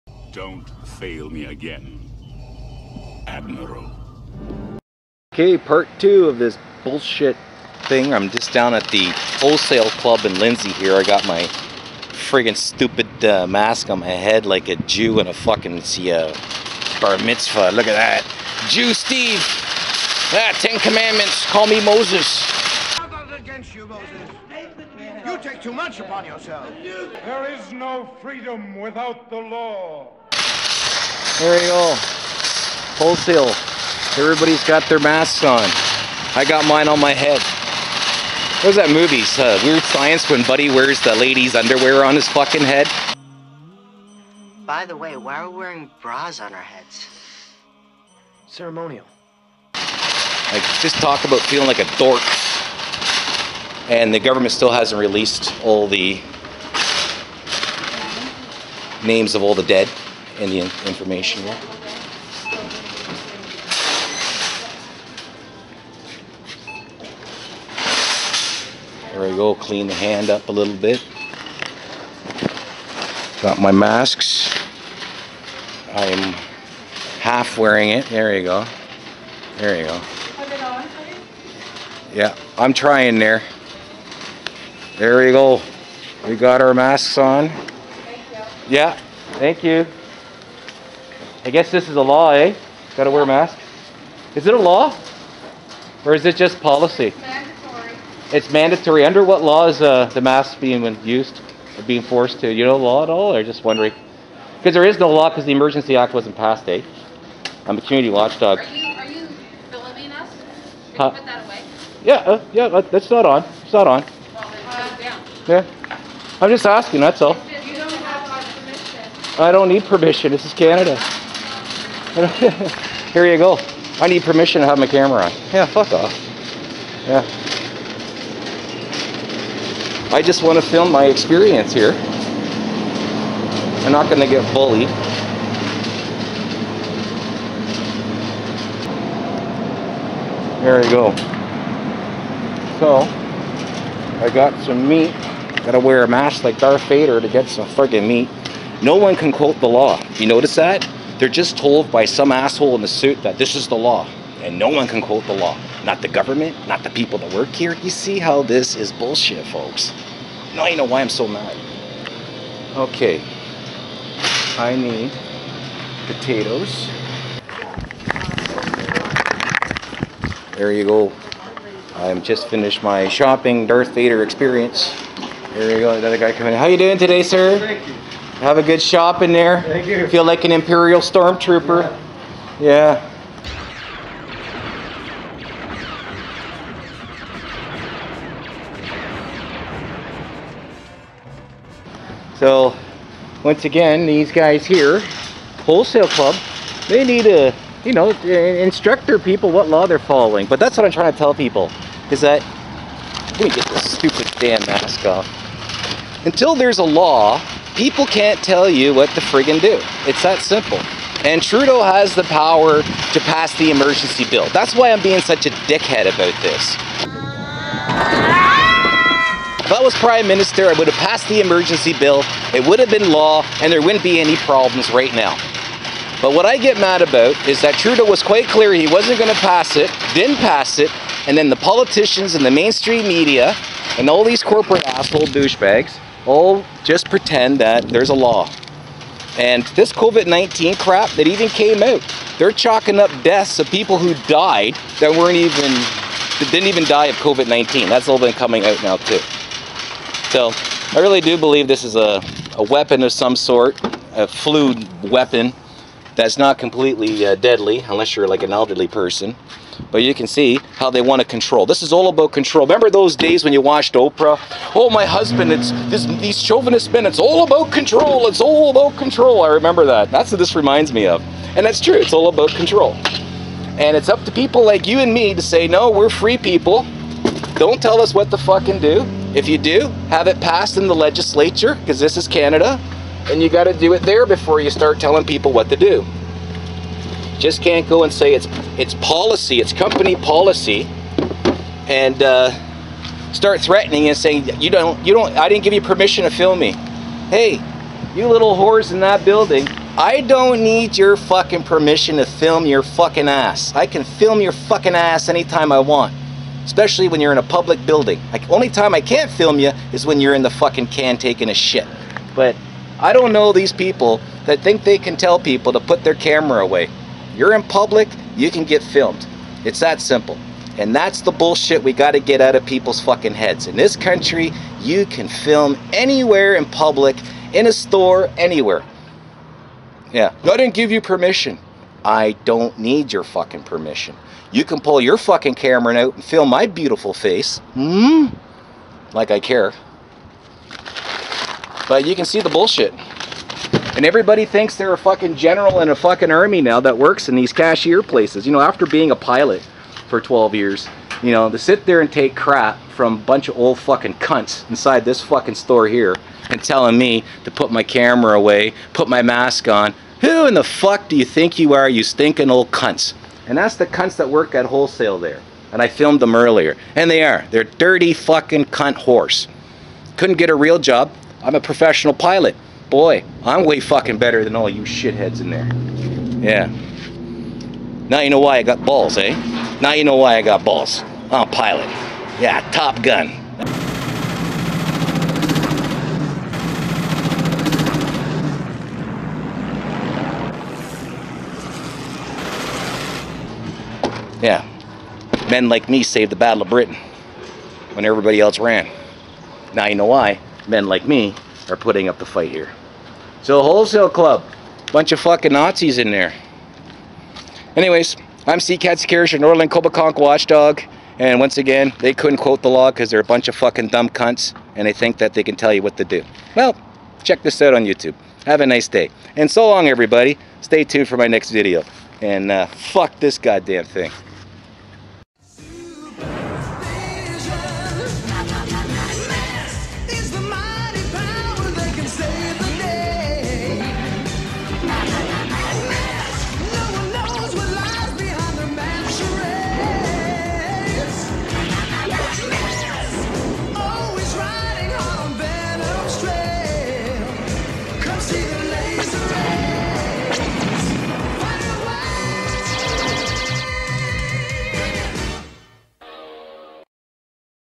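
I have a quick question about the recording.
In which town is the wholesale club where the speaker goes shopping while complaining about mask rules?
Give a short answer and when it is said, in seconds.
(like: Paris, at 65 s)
Lindsay, at 10 s.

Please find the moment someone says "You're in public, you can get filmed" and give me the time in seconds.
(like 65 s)
317 s.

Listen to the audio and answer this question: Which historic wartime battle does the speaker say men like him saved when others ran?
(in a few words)
Battle of Britain.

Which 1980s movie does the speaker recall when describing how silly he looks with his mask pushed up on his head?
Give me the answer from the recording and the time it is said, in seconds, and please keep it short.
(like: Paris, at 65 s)
Weird Science, at 39 s.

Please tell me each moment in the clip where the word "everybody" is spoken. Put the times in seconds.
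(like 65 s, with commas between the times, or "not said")
34 s, 344 s, 398 s, 419 s.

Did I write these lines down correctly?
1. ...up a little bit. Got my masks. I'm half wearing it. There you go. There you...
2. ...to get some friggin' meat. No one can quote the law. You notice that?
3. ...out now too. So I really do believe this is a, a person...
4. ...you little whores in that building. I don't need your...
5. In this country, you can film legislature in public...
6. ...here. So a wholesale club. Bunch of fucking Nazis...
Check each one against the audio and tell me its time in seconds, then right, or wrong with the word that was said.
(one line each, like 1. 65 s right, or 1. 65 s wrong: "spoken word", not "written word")
1. 70 s right
2. 147 s right
3. 248 s wrong: "weapon", not "person"
4. 298 s right
5. 323 s wrong: "anywhere", not "legislature"
6. 402 s right.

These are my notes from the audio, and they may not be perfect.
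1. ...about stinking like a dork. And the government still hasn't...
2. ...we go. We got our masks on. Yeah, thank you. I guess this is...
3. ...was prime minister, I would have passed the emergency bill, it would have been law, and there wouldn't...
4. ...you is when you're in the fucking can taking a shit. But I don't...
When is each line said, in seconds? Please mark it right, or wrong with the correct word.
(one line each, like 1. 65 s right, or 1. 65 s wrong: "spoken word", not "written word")
1. 51 s wrong: "feeling", not "stinking"
2. 85 s right
3. 219 s right
4. 309 s right.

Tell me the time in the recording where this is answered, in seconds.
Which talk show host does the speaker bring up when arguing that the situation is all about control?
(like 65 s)
263 s.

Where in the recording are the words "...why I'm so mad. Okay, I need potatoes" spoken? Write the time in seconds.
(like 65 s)
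160 s.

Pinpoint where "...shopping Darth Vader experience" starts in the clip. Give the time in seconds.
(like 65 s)
173 s.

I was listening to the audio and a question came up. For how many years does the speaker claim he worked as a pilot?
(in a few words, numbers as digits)
12.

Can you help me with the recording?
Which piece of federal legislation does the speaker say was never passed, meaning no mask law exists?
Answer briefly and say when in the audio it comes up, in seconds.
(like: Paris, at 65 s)
Emergency Act, at 105 s.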